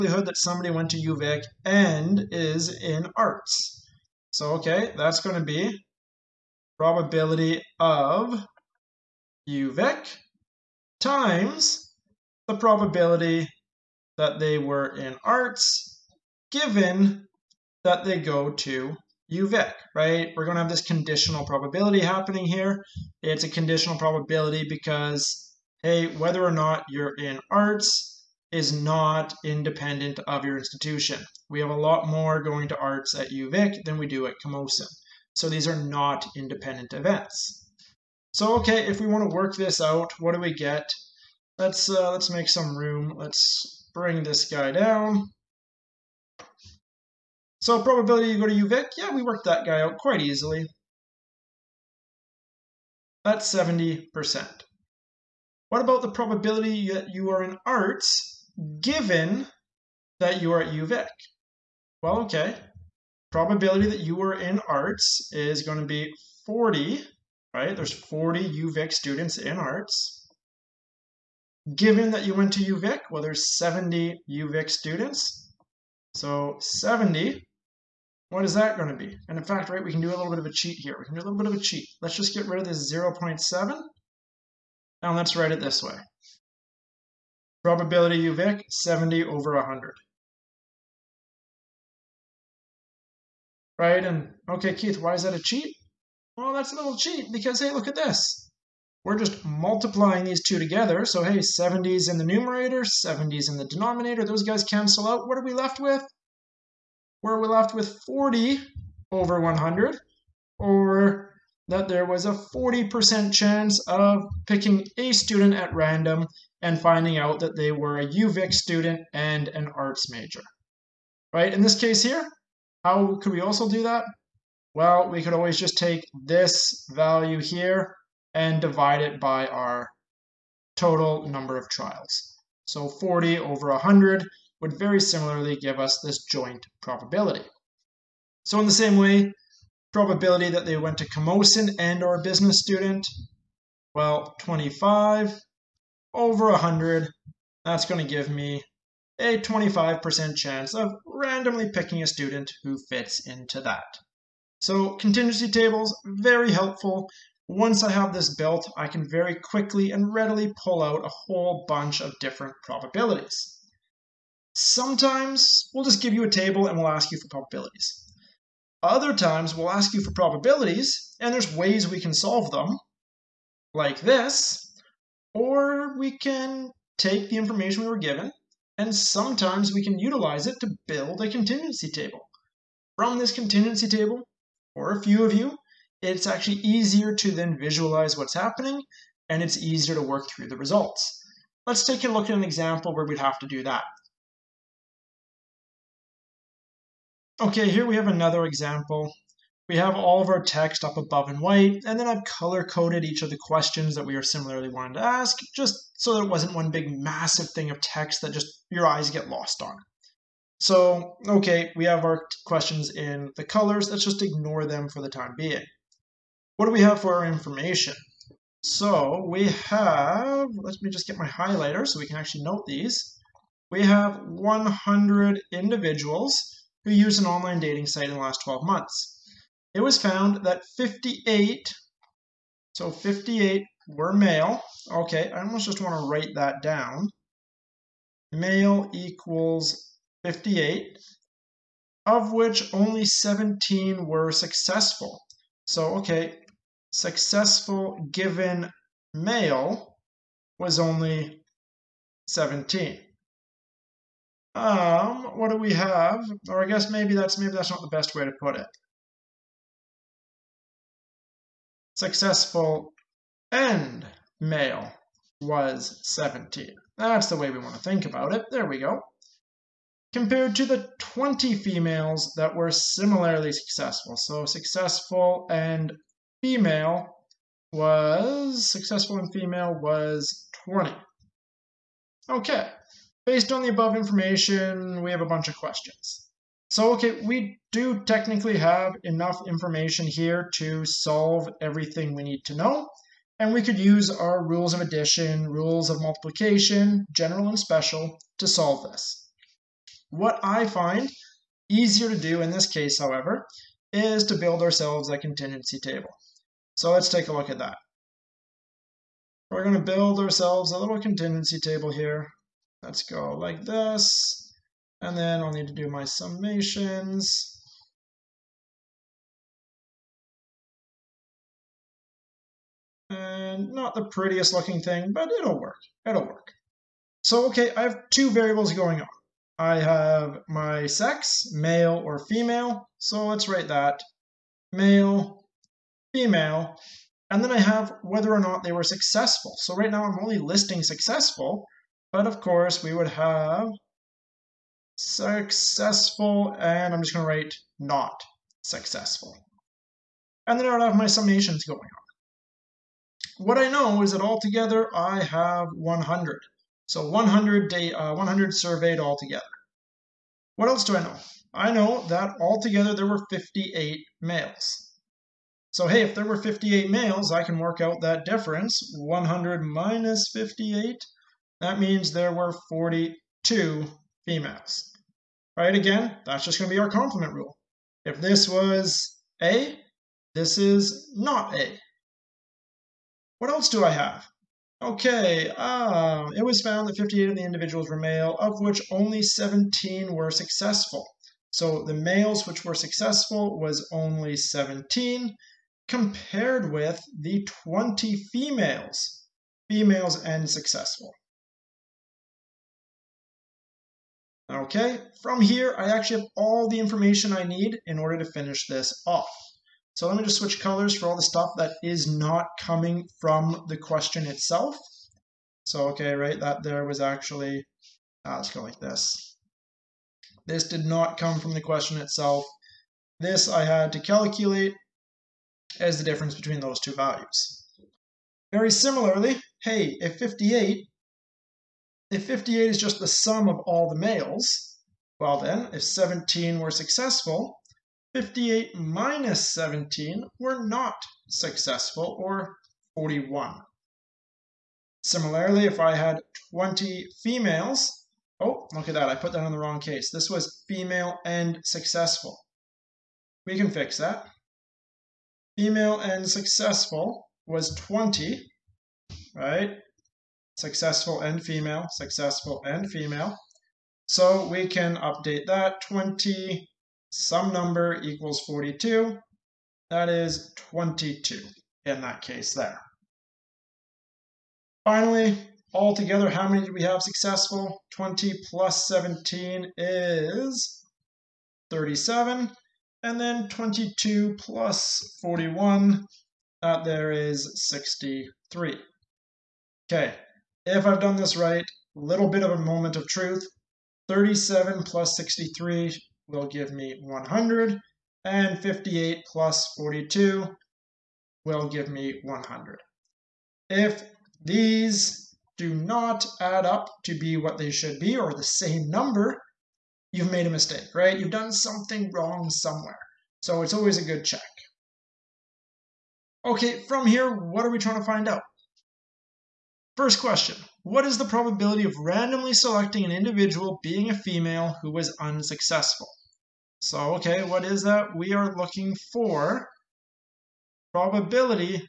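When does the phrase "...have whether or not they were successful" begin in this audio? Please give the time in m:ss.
5:37.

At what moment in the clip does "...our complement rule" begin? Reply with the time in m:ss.
6:16.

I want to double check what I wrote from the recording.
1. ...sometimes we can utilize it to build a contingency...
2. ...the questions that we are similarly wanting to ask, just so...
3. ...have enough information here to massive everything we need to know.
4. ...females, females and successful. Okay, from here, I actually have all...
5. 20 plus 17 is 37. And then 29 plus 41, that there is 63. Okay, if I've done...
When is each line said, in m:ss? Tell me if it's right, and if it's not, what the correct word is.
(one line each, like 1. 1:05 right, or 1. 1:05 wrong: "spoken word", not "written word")
1. 2:58 right
2. 3:23 right
3. 4:48 wrong: "solve", not "massive"
4. 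6:38 right
5. 7:57 wrong: "22", not "29".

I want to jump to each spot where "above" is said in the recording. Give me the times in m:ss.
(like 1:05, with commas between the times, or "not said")
3:20, 4:43.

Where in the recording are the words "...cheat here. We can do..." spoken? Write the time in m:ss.
1:20.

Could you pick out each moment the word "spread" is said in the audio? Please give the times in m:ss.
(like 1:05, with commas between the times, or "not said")
not said.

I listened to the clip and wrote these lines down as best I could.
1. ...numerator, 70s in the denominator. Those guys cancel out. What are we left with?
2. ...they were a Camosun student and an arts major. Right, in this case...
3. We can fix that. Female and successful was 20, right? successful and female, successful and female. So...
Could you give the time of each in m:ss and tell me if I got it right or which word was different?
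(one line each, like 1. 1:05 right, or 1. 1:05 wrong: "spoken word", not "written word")
1. 1:42 right
2. 1:57 wrong: "UVic", not "Camosun"
3. 7:33 right.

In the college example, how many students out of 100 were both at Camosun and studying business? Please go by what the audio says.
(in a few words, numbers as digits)
25.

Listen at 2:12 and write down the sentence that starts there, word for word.
So 40 over 100 would very similarly give us this joint probability.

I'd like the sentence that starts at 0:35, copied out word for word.
So these are not independent events.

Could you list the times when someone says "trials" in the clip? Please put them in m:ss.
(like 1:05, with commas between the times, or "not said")
2:11.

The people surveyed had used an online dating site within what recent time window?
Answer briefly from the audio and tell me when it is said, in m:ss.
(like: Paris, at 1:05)
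12 months, at 3:48.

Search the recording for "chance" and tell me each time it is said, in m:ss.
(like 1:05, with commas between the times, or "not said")
1:53, 2:30.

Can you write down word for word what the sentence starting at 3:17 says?
Okay, here we have another example.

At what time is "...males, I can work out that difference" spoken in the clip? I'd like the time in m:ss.
6:06.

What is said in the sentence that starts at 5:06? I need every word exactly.
So let's take a look at that.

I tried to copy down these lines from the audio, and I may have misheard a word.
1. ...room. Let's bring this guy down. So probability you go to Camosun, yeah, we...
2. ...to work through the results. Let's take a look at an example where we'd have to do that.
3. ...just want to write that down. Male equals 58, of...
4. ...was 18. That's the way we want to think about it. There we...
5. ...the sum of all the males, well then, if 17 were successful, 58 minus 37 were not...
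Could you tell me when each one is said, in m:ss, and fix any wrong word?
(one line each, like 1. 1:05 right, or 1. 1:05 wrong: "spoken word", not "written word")
1. 0:42 wrong: "UVic", not "Camosun"
2. 3:09 right
3. 3:55 right
4. 4:25 wrong: "17", not "18"
5. 7:12 wrong: "17", not "37".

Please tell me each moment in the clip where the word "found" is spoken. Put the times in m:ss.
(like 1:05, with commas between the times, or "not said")
3:49, 6:26.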